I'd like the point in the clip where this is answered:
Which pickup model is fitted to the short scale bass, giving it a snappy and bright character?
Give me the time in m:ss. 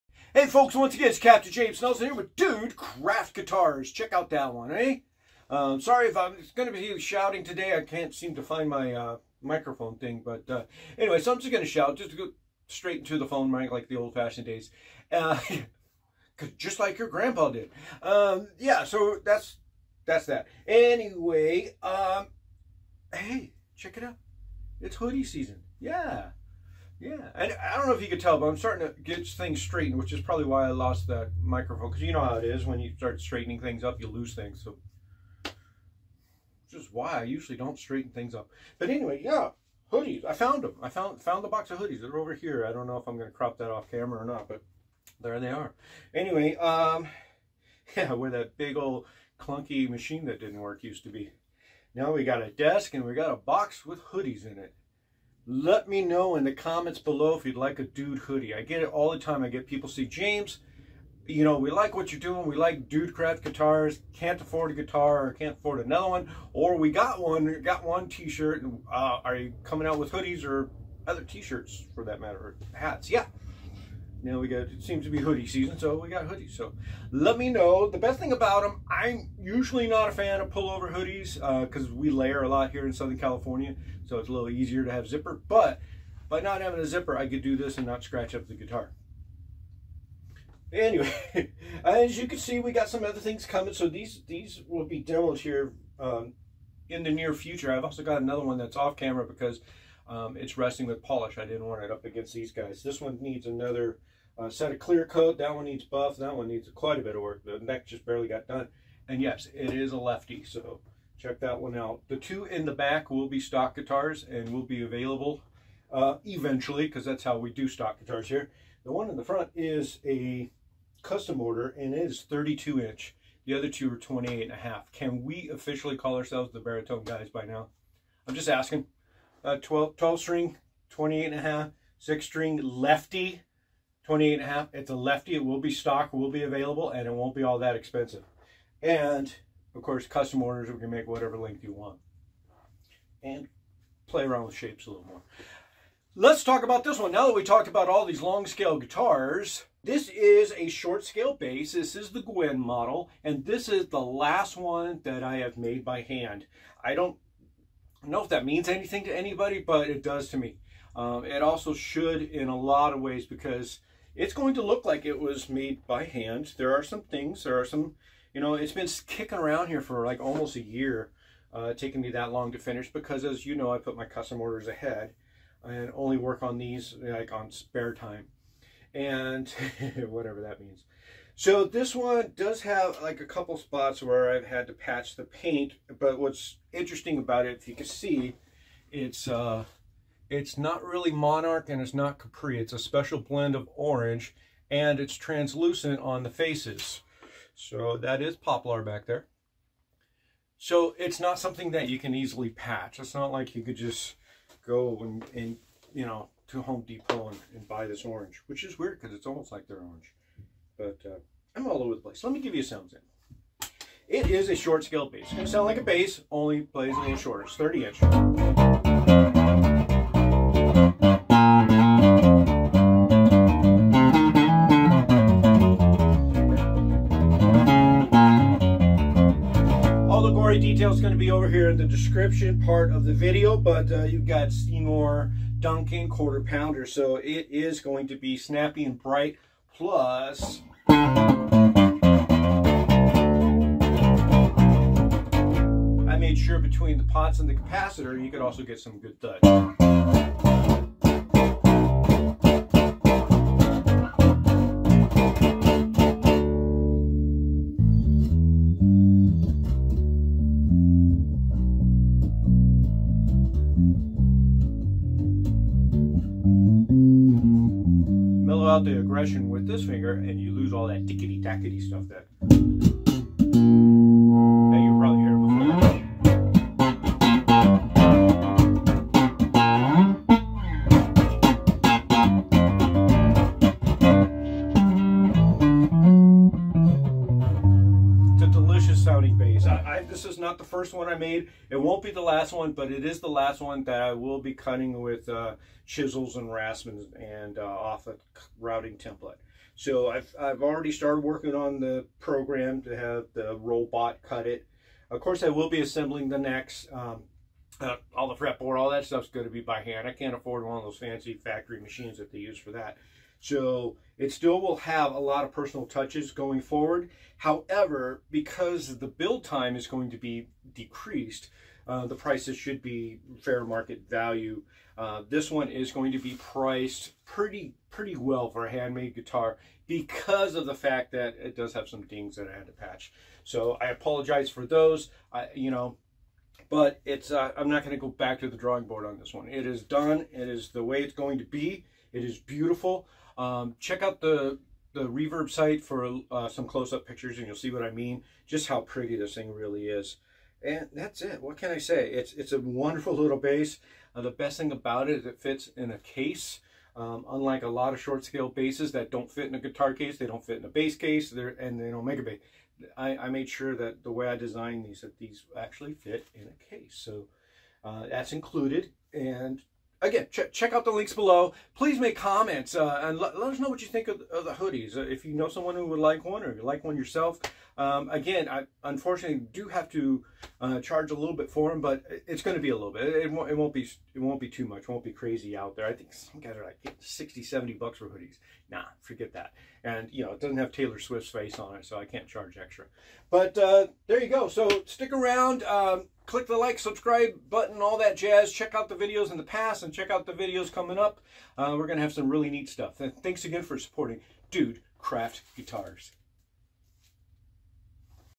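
3:54.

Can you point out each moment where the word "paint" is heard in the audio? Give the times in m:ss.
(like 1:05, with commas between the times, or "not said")
3:05.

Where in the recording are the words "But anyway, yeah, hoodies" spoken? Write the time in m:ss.
0:38.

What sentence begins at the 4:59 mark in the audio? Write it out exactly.
So I've, I've already started working on the program to have the robot cut it.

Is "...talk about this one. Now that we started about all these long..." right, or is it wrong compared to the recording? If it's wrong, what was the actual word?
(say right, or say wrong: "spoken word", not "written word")
wrong: "talked", not "started".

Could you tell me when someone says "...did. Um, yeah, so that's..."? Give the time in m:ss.
0:17.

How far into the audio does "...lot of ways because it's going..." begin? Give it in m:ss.
2:42.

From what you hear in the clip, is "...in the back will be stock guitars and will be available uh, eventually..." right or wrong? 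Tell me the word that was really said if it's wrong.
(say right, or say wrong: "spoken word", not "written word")
right.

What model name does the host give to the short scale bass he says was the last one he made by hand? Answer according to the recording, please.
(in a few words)
Gwen.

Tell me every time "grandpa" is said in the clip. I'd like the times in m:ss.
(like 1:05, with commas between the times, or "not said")
0:17.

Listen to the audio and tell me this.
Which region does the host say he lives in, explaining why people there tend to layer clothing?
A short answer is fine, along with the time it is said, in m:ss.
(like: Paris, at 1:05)
Southern California, at 1:22.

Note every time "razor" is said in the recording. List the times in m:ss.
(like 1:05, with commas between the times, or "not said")
not said.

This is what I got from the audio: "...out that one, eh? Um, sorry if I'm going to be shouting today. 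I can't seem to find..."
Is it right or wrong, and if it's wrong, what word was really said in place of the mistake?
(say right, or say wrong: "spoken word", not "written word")
right.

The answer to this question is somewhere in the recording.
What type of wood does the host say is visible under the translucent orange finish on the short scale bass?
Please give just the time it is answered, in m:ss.
3:18.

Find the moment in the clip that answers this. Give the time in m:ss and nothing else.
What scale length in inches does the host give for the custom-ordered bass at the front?
2:02.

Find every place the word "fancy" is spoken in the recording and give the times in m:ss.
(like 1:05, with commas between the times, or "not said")
5:10.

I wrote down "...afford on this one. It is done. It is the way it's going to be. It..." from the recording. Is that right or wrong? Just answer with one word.
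wrong.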